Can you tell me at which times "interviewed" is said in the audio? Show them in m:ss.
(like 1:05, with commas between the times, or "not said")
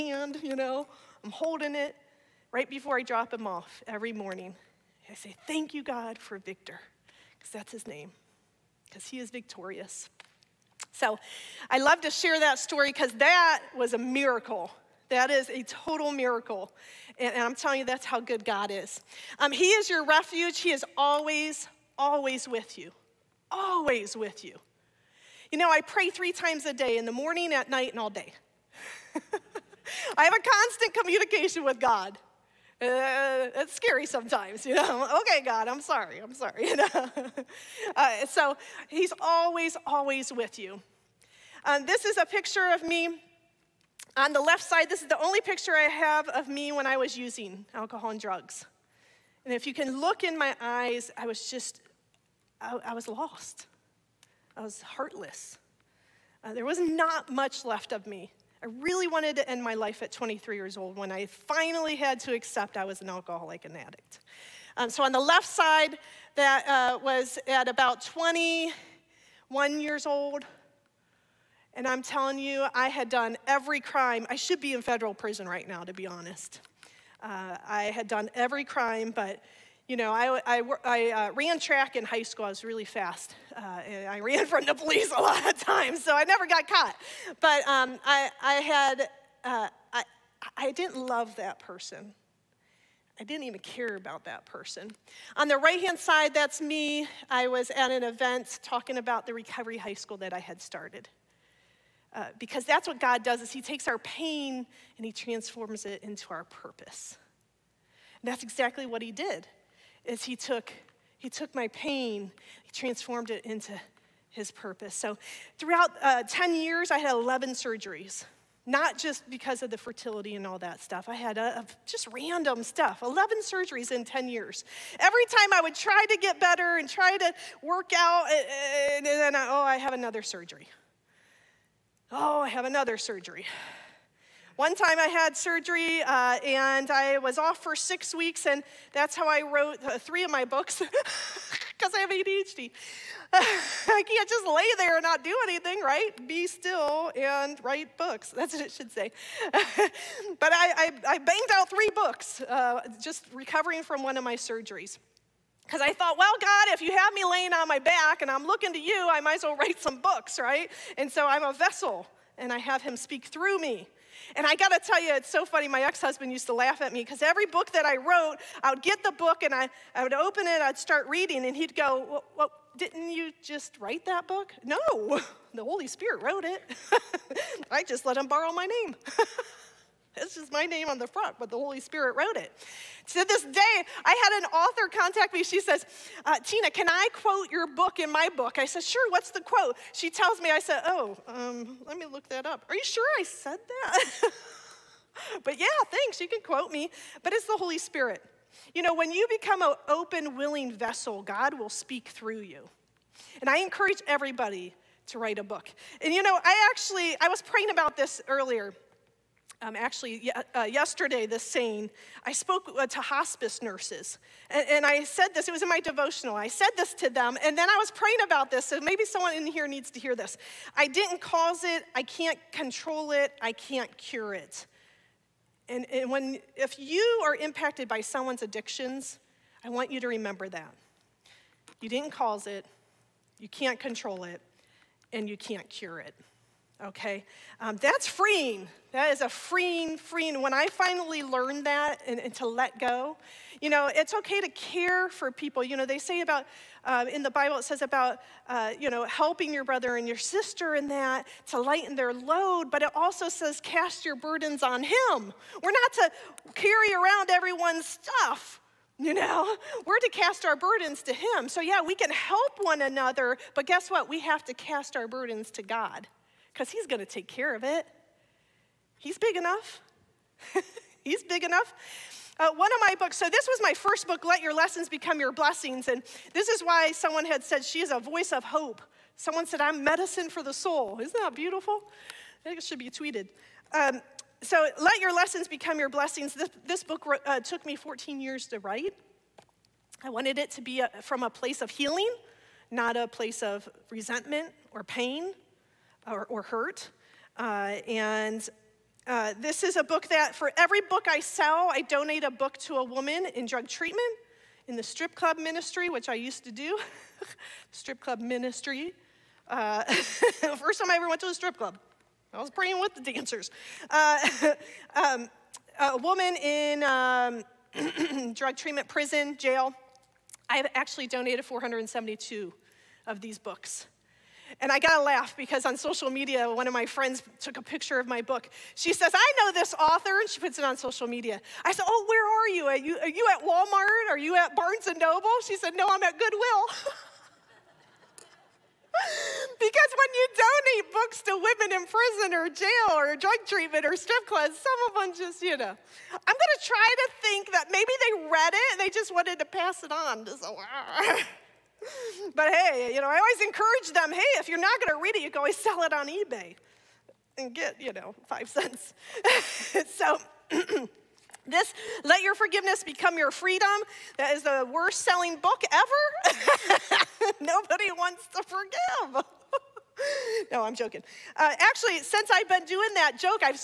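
not said.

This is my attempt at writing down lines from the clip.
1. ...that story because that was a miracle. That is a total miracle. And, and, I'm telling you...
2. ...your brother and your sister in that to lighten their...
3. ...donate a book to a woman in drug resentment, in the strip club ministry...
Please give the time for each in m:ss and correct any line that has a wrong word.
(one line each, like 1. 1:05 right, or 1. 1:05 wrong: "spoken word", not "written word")
1. 0:12 right
2. 4:09 right
3. 5:01 wrong: "treatment", not "resentment".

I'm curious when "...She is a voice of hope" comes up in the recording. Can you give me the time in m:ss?
4:37.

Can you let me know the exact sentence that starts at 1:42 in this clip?
Uh, because that's what God does is he takes our pain and he transforms it into our purpose.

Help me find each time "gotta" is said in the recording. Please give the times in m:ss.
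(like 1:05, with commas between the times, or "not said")
2:44, 5:24.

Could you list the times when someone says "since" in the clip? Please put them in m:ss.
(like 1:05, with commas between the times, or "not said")
6:12.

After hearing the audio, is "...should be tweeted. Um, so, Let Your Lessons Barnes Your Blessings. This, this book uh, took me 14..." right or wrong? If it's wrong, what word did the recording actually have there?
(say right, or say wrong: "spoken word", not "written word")
wrong: "Become", not "Barnes".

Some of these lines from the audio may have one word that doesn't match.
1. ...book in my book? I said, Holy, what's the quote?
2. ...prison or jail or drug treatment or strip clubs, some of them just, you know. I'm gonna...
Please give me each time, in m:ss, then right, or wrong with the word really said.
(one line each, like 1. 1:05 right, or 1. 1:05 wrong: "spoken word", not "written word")
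1. 3:07 wrong: "Sure", not "Holy"
2. 5:41 right.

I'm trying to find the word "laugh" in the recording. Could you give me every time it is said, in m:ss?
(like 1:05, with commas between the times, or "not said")
2:46, 5:25.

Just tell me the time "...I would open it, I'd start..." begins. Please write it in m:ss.
2:49.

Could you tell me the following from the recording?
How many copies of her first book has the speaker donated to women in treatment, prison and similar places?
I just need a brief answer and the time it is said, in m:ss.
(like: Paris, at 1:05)
472, at 5:21.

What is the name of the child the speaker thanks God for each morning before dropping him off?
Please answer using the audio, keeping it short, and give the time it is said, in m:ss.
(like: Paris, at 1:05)
Victor, at 0:06.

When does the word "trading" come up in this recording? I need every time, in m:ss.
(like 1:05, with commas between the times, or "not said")
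not said.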